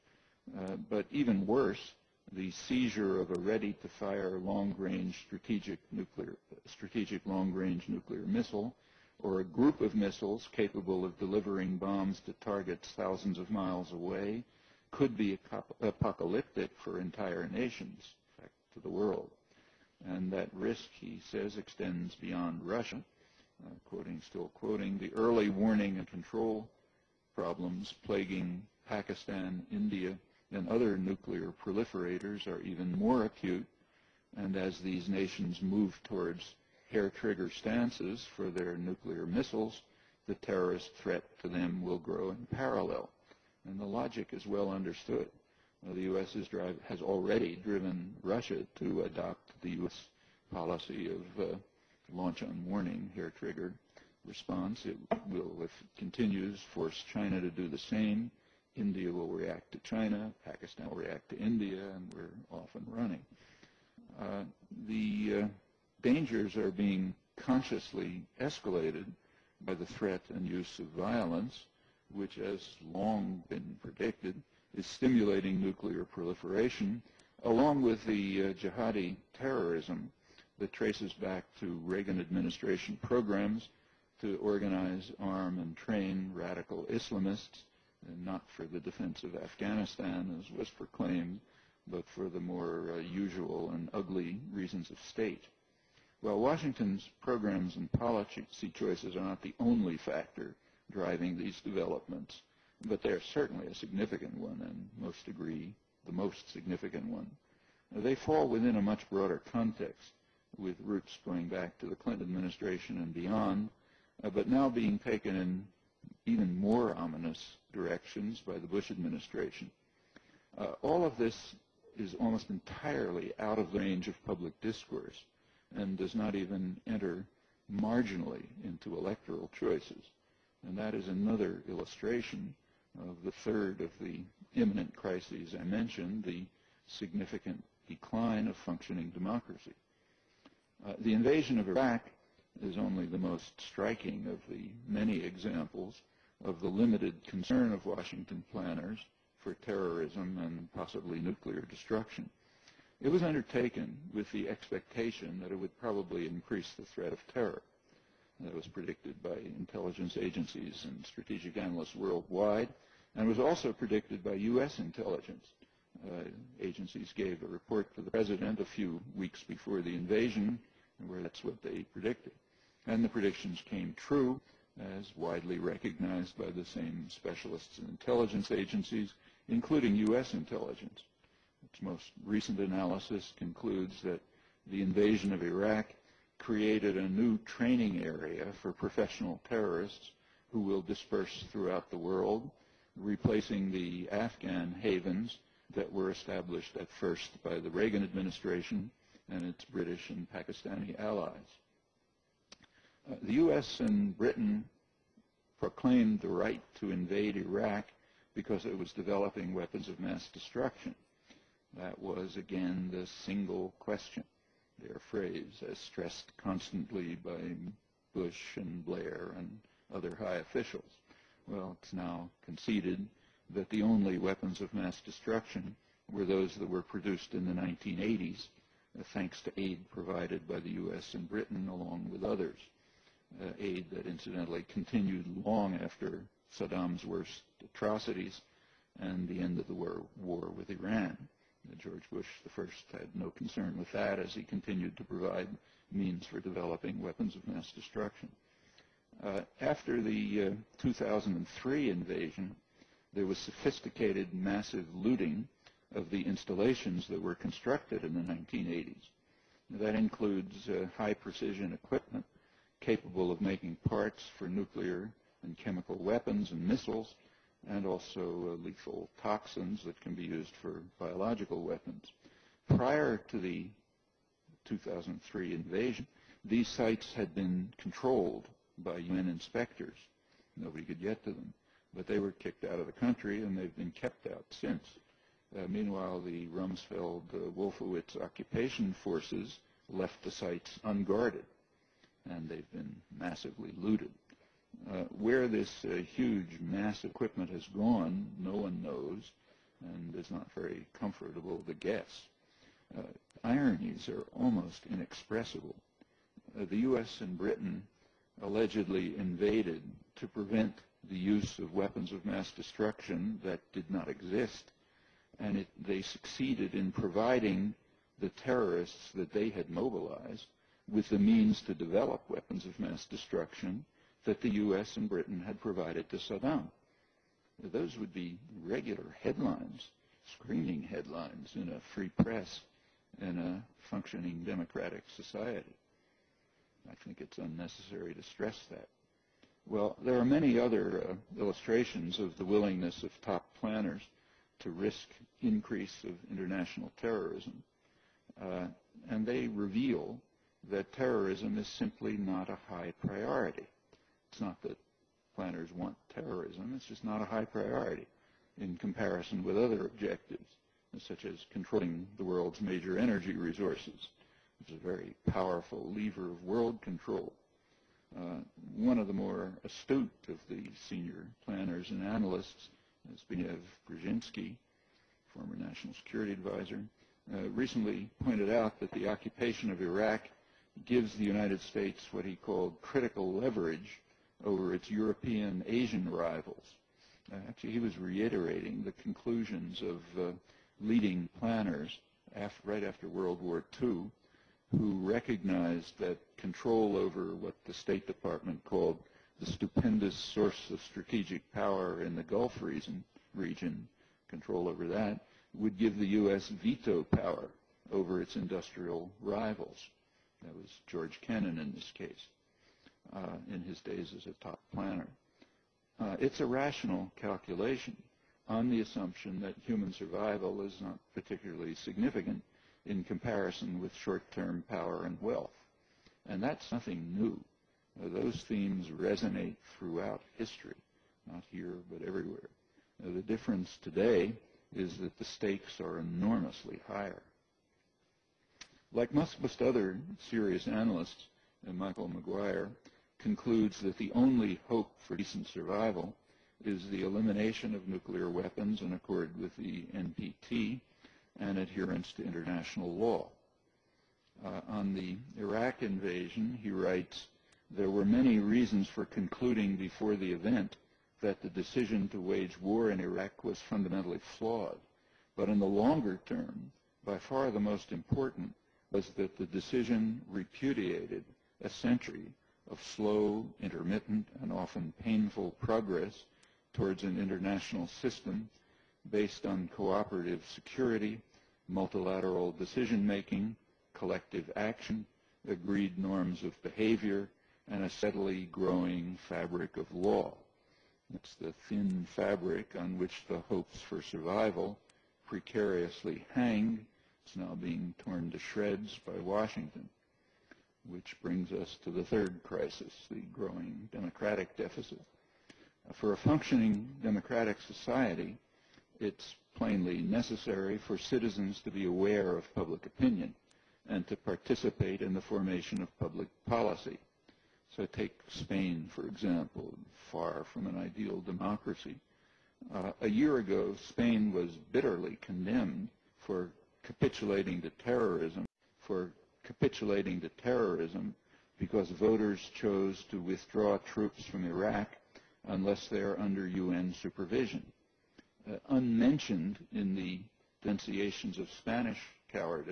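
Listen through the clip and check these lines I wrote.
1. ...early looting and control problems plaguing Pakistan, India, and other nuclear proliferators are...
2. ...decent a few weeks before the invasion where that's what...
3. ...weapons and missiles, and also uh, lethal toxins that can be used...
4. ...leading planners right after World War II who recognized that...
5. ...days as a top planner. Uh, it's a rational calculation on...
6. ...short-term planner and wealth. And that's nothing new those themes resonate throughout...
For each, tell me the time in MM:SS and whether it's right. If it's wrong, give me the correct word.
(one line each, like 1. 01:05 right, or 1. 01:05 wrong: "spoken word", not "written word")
1. 00:25 wrong: "warning", not "looting"
2. 02:48 wrong: "president", not "decent"
3. 04:25 right
4. 06:30 right
5. 06:53 right
6. 07:03 wrong: "power", not "planner".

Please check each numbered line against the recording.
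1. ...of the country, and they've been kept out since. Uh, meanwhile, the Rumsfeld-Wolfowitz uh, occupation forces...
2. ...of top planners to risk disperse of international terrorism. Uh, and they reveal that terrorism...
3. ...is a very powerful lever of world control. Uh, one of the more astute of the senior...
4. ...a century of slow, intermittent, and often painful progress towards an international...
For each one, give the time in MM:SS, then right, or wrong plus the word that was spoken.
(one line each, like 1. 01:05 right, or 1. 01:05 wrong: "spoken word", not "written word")
1. 04:42 right
2. 05:43 wrong: "increase", not "disperse"
3. 06:04 right
4. 07:51 right.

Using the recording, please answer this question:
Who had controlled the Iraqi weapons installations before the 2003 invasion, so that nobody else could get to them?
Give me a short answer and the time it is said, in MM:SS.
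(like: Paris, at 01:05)
UN inspectors, at 04:38.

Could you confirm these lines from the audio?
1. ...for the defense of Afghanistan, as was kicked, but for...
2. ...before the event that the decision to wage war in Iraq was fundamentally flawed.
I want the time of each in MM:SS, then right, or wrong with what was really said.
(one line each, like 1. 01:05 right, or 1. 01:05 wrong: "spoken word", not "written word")
1. 01:28 wrong: "proclaimed", not "kicked"
2. 07:39 right.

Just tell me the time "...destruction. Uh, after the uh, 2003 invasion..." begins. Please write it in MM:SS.
04:07.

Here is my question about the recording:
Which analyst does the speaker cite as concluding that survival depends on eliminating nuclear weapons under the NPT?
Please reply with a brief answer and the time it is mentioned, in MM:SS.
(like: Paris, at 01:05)
Michael MccGwire, at 07:21.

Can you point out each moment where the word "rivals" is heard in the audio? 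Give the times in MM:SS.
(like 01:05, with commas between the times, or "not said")
06:26, 06:49.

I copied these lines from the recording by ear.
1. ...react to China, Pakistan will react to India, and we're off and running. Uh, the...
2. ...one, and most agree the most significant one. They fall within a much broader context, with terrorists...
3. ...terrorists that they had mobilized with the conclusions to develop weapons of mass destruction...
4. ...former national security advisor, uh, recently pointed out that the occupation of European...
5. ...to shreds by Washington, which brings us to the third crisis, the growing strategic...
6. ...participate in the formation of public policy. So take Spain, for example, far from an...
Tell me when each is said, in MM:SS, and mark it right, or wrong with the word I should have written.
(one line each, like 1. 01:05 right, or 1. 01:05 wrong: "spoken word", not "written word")
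1. 00:59 right
2. 01:44 wrong: "roots", not "terrorists"
3. 05:18 wrong: "means", not "conclusions"
4. 06:15 wrong: "Iraq", not "European"
5. 08:18 wrong: "democratic", not "strategic"
6. 08:34 right.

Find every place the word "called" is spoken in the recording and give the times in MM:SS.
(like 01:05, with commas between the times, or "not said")
06:22, 06:38.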